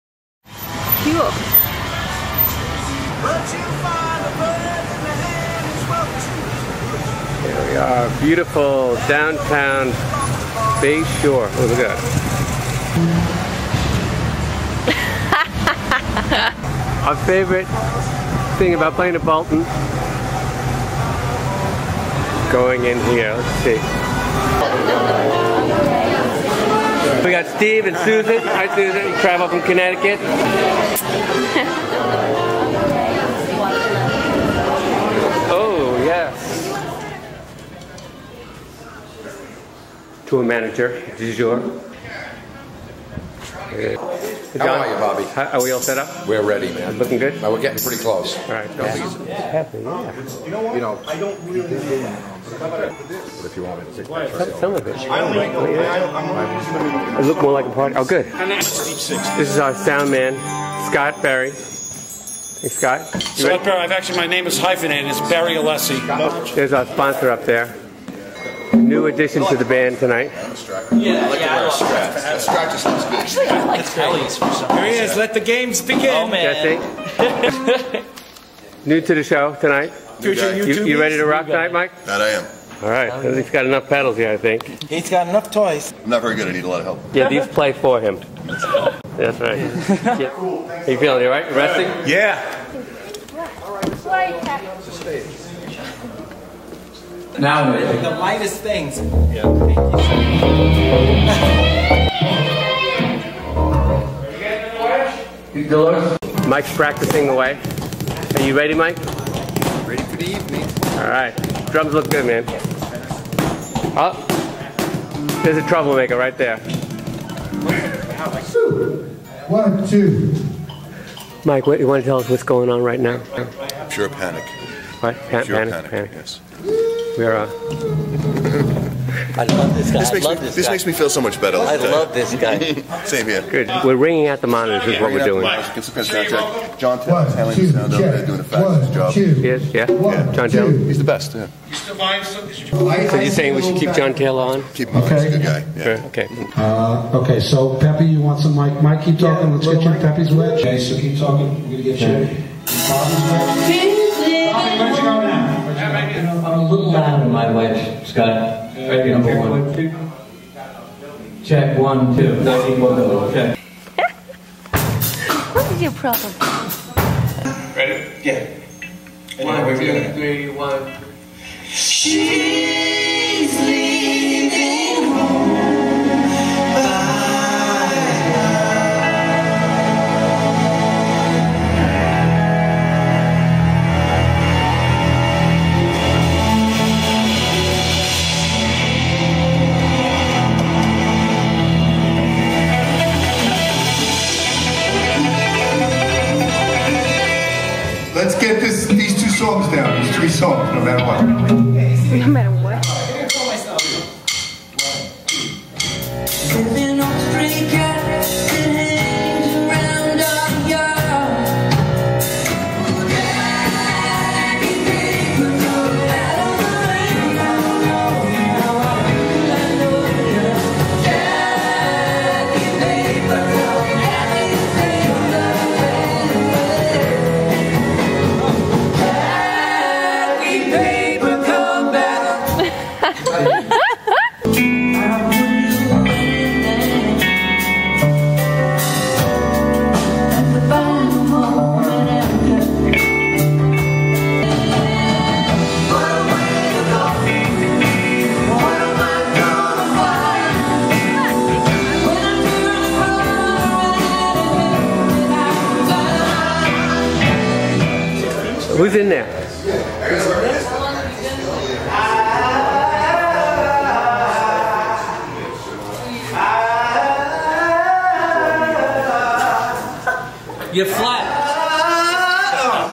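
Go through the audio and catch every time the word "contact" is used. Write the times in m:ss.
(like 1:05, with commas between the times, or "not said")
2:15.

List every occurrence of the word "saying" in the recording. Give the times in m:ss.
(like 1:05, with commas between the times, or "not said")
2:23.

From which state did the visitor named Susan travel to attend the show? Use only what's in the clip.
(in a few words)
Connecticut.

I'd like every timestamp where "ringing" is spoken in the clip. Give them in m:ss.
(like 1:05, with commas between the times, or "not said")
2:13.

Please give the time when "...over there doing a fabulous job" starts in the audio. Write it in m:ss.
2:17.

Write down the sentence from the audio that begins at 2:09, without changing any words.
This, makes, me, this this guy.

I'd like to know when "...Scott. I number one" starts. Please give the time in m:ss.
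2:38.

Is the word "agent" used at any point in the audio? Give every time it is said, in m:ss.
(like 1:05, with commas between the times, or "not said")
not said.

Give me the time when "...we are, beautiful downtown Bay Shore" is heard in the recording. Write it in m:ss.
0:07.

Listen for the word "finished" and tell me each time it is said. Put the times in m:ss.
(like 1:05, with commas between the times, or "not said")
not said.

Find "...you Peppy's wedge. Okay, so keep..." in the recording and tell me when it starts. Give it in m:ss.
2:29.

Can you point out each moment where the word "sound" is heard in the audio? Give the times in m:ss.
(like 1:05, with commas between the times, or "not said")
0:59, 2:17.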